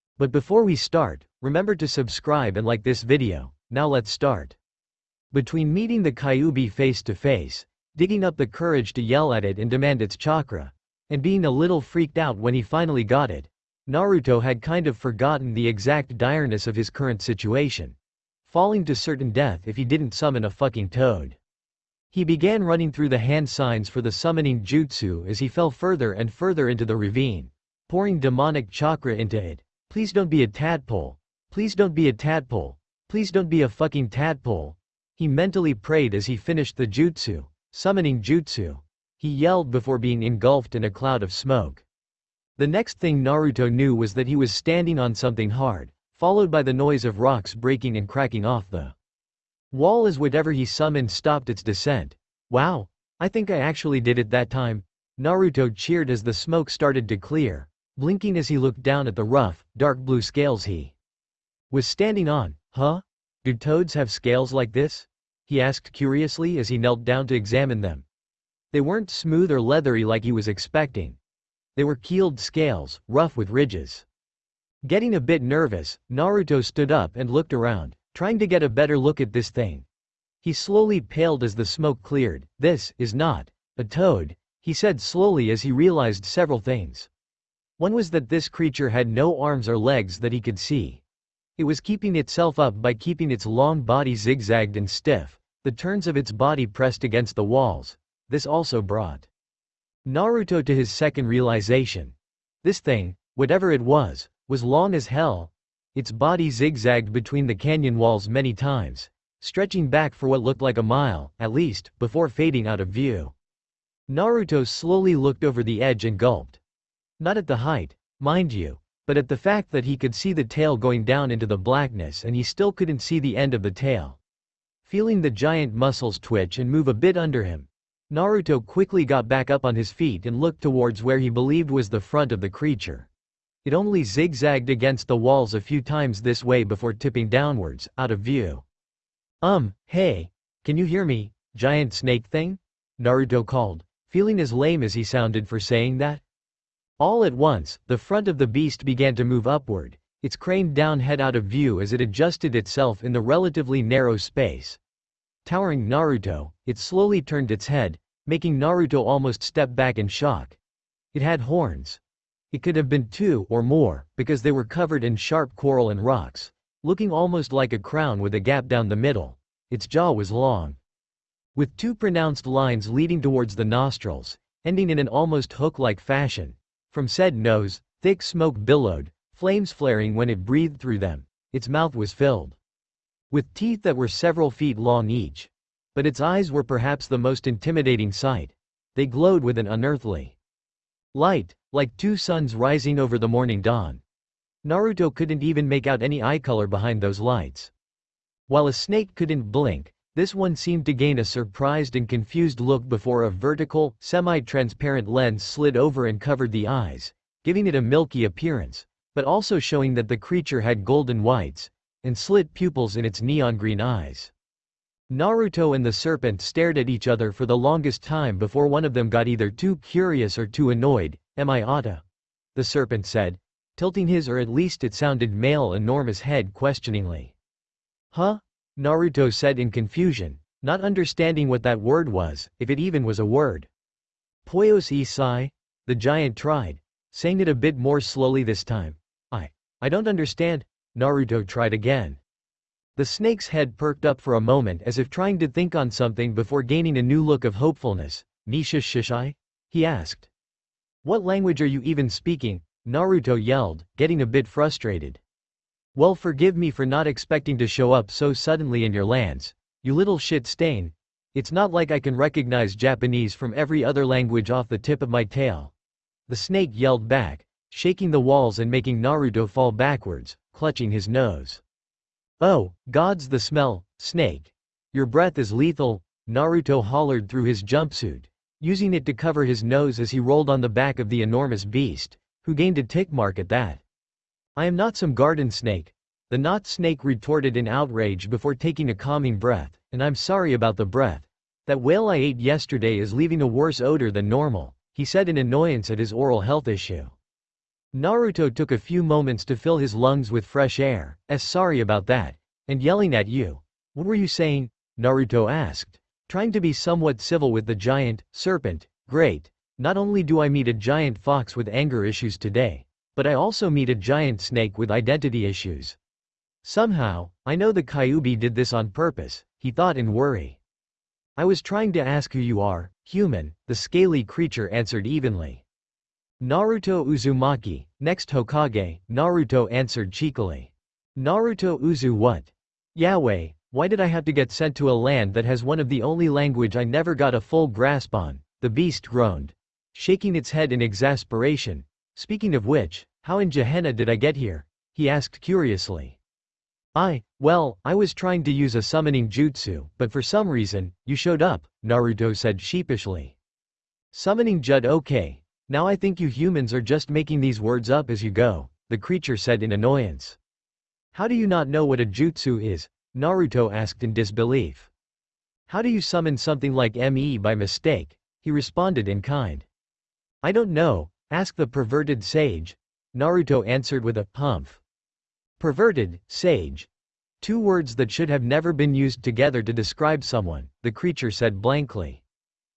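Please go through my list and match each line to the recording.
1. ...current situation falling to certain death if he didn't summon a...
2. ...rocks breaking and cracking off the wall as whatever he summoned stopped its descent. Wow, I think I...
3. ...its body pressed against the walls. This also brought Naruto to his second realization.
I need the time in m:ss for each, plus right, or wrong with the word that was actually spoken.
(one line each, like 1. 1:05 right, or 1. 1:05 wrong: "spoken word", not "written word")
1. 0:16 right
2. 0:47 right
3. 1:36 right.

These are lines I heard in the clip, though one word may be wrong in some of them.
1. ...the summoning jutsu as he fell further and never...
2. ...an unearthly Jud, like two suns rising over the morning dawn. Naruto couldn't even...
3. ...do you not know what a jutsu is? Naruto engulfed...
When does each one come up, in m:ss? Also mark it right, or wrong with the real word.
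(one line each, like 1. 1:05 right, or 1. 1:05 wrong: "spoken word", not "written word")
1. 0:24 wrong: "further", not "never"
2. 3:09 wrong: "Light", not "Jud"
3. 6:01 wrong: "asked", not "engulfed".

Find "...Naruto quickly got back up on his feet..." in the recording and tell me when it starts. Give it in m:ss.
2:08.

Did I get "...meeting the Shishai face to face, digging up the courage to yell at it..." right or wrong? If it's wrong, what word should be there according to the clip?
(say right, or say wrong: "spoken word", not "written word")
wrong: "Kyuubi", not "Shishai".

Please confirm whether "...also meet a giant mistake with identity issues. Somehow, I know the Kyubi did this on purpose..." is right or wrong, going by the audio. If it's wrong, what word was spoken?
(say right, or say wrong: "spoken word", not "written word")
wrong: "snake", not "mistake".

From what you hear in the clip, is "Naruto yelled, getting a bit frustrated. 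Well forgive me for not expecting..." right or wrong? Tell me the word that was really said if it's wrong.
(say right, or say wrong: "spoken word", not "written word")
right.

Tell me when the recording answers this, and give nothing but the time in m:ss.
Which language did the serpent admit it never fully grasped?
4:22.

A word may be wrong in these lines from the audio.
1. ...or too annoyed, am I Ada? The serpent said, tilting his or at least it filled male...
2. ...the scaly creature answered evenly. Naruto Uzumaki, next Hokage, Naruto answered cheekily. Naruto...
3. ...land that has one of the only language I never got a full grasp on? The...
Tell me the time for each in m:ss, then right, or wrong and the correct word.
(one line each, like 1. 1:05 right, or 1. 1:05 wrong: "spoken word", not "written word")
1. 3:40 wrong: "sounded", not "filled"
2. 5:23 right
3. 5:34 right.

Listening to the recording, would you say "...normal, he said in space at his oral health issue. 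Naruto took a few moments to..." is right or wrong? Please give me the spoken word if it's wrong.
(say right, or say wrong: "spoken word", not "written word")
wrong: "annoyance", not "space".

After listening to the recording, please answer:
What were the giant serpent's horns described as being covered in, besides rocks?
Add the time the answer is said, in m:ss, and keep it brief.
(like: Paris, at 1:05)
sharp coral, at 2:45.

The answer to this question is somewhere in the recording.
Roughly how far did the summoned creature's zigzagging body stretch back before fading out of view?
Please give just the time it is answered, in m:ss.
1:50.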